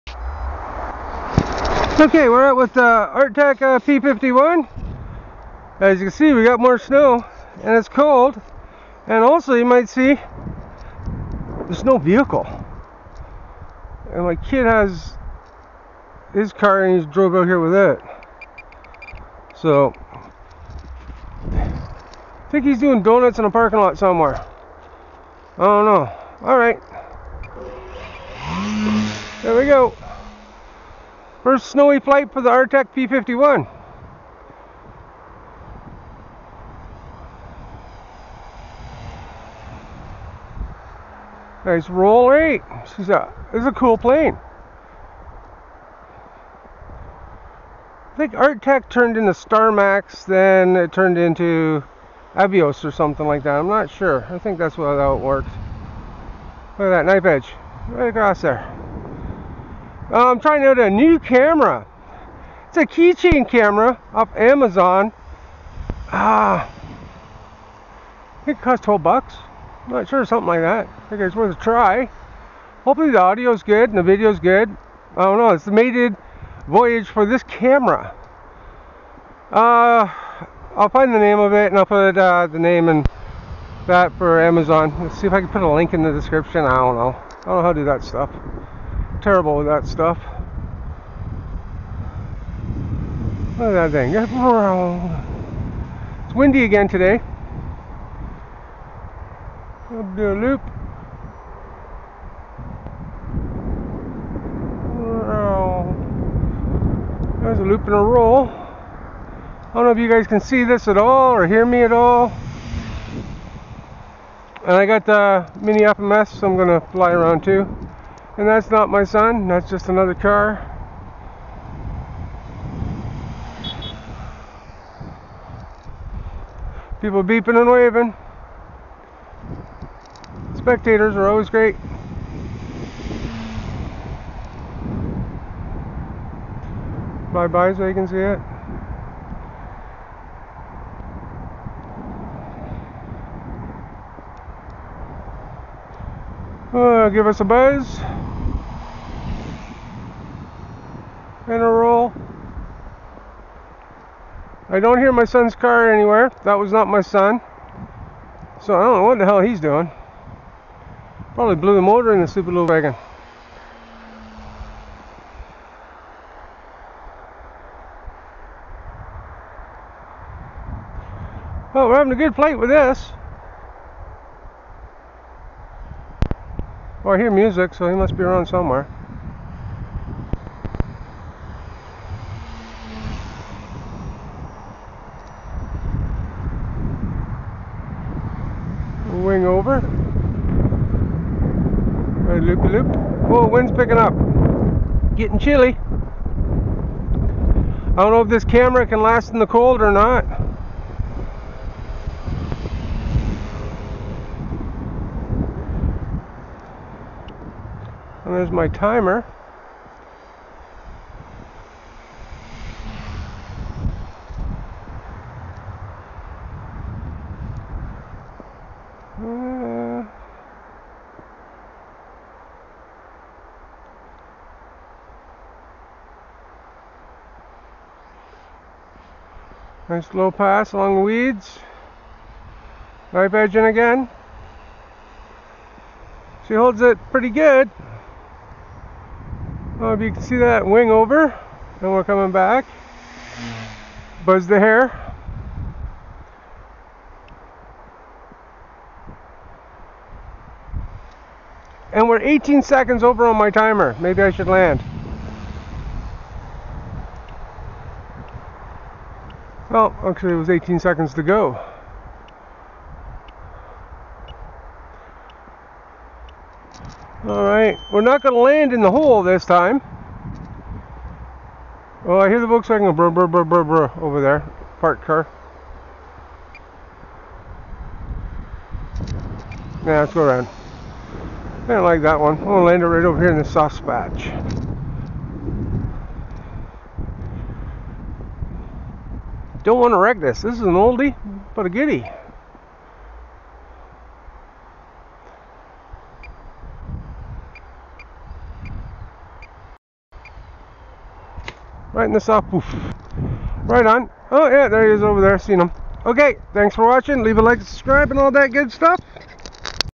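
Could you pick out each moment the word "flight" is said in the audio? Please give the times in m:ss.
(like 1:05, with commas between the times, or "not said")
0:31, 2:52.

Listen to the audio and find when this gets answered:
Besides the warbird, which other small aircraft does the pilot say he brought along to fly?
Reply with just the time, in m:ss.
1:55.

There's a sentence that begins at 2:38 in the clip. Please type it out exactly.
So I don't know what the hell he's doing.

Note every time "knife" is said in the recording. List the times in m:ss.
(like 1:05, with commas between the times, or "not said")
0:57, 3:53.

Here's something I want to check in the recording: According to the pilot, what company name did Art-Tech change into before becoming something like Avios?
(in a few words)
Starmax.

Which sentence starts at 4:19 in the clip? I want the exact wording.
Well, actually it was 18 seconds to go.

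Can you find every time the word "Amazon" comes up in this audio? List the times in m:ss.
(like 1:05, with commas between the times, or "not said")
1:04, 1:24.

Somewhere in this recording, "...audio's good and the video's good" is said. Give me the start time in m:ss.
1:13.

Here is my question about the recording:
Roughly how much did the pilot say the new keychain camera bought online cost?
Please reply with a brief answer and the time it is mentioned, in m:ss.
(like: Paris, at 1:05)
12 bucks, at 1:08.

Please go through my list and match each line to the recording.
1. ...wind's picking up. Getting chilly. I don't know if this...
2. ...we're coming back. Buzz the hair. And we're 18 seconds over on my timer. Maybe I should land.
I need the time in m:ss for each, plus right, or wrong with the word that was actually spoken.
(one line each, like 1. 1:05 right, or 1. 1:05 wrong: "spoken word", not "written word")
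1. 3:13 right
2. 4:01 right.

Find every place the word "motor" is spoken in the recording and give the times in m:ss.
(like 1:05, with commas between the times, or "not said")
2:41.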